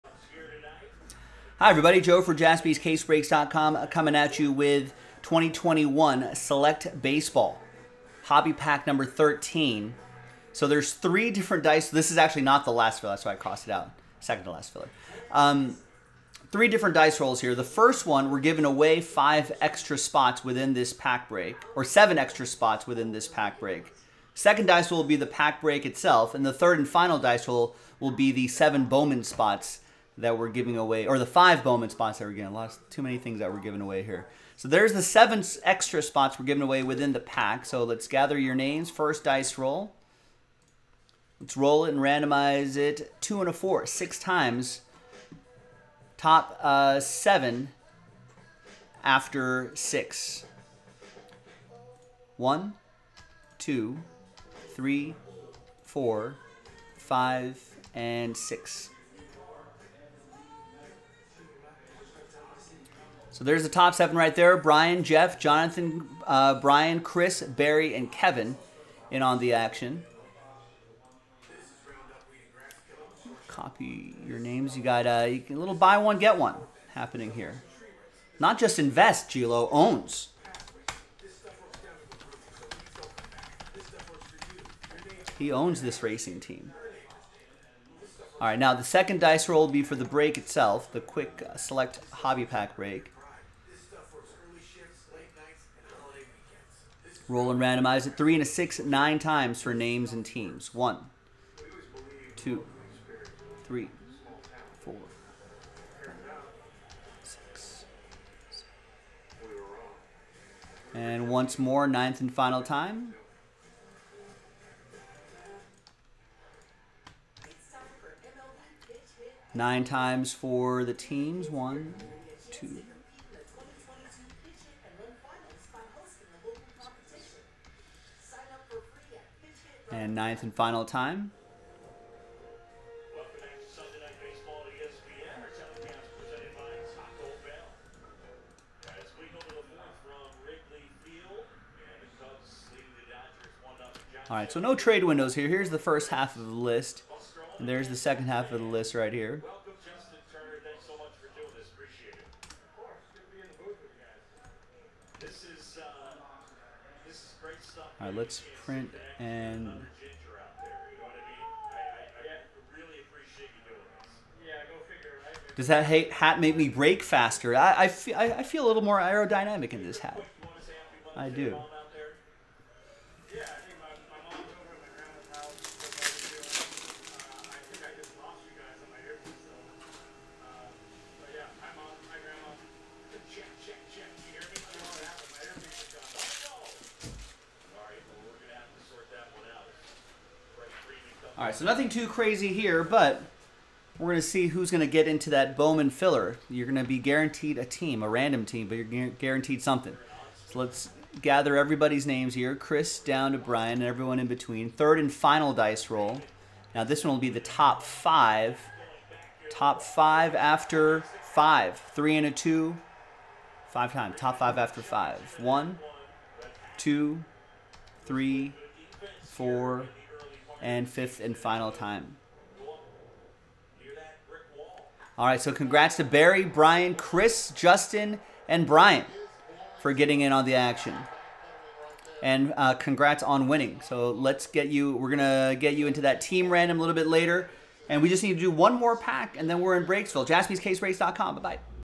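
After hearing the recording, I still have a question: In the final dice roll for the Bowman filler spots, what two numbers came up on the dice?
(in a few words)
3 and 2.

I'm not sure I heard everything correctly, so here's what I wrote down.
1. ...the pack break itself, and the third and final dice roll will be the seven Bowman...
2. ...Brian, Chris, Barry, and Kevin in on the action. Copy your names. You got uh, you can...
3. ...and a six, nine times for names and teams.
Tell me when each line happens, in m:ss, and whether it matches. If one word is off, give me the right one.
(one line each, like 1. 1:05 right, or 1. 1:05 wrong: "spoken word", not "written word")
1. 0:25 right
2. 1:06 right
3. 1:38 right.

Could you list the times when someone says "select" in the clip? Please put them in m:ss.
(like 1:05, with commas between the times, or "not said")
0:06, 1:31.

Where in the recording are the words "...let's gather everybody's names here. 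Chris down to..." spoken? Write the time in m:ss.
3:20.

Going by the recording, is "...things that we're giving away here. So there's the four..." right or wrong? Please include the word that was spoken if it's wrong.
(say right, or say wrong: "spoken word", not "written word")
wrong: "seven", not "four".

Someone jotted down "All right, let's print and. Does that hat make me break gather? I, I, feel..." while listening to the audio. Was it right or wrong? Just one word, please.
wrong.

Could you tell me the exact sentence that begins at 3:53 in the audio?
So let's get you, we're going to get you into that team random a little bit later.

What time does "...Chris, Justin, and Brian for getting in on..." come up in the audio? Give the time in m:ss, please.
3:46.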